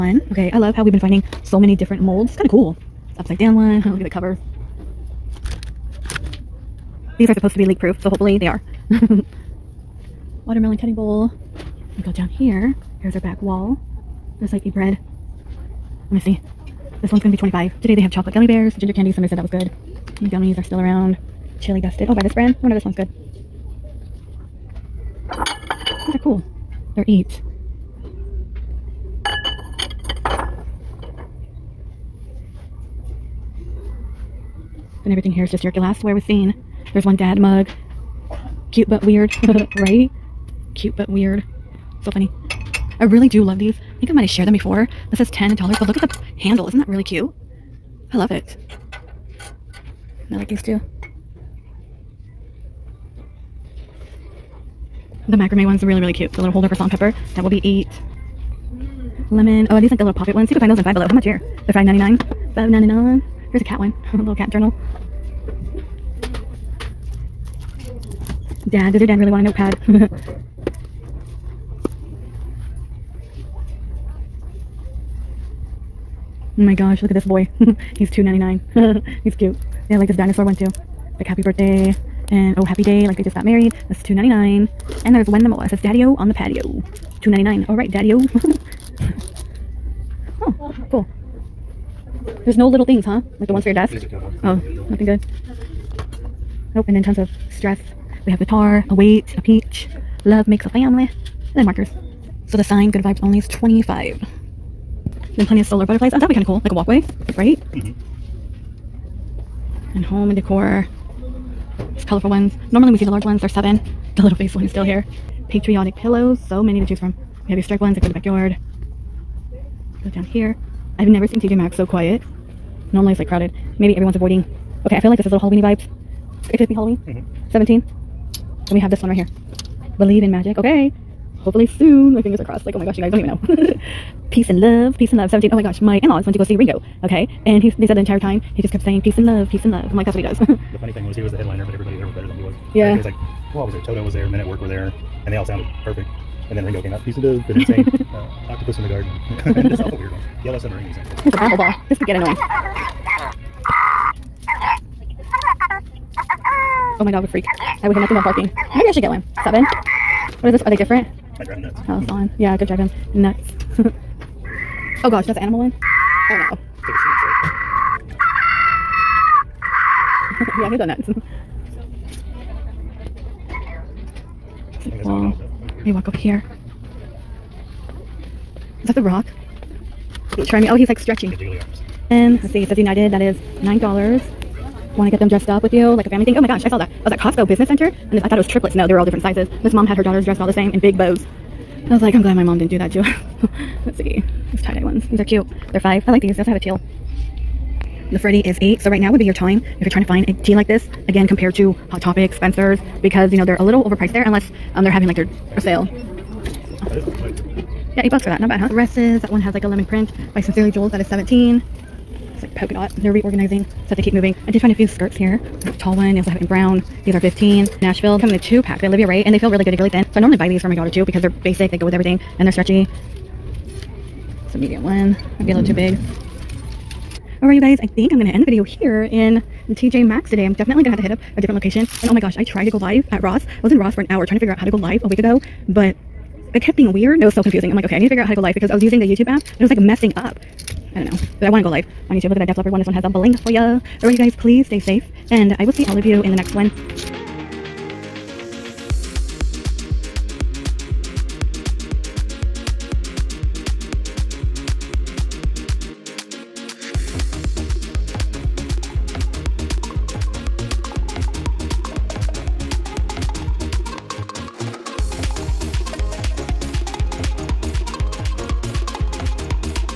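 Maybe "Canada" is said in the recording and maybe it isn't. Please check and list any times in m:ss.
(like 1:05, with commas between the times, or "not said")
not said.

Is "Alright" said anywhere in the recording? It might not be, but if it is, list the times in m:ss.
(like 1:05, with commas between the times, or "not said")
1:27, 3:47, 4:04.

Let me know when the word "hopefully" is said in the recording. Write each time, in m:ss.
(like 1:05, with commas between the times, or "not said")
0:08, 2:11.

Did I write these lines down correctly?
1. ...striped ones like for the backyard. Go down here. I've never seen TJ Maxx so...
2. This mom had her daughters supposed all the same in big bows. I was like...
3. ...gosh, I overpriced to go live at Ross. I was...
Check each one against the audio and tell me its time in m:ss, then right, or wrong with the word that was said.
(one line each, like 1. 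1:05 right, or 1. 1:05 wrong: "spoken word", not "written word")
1. 1:57 right
2. 3:09 wrong: "dressed", not "supposed"
3. 3:52 wrong: "tried", not "overpriced".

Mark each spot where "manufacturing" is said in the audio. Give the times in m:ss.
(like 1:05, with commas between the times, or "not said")
not said.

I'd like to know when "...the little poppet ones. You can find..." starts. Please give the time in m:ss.
0:59.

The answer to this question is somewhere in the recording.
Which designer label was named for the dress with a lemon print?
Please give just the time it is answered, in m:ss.
3:30.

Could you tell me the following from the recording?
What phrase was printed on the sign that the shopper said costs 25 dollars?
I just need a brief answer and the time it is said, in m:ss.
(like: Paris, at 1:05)
Good vibes only, at 1:42.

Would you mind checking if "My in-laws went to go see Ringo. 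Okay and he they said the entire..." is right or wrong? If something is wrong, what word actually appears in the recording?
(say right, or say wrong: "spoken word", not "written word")
right.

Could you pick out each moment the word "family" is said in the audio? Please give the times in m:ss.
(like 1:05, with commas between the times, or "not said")
1:40, 3:06.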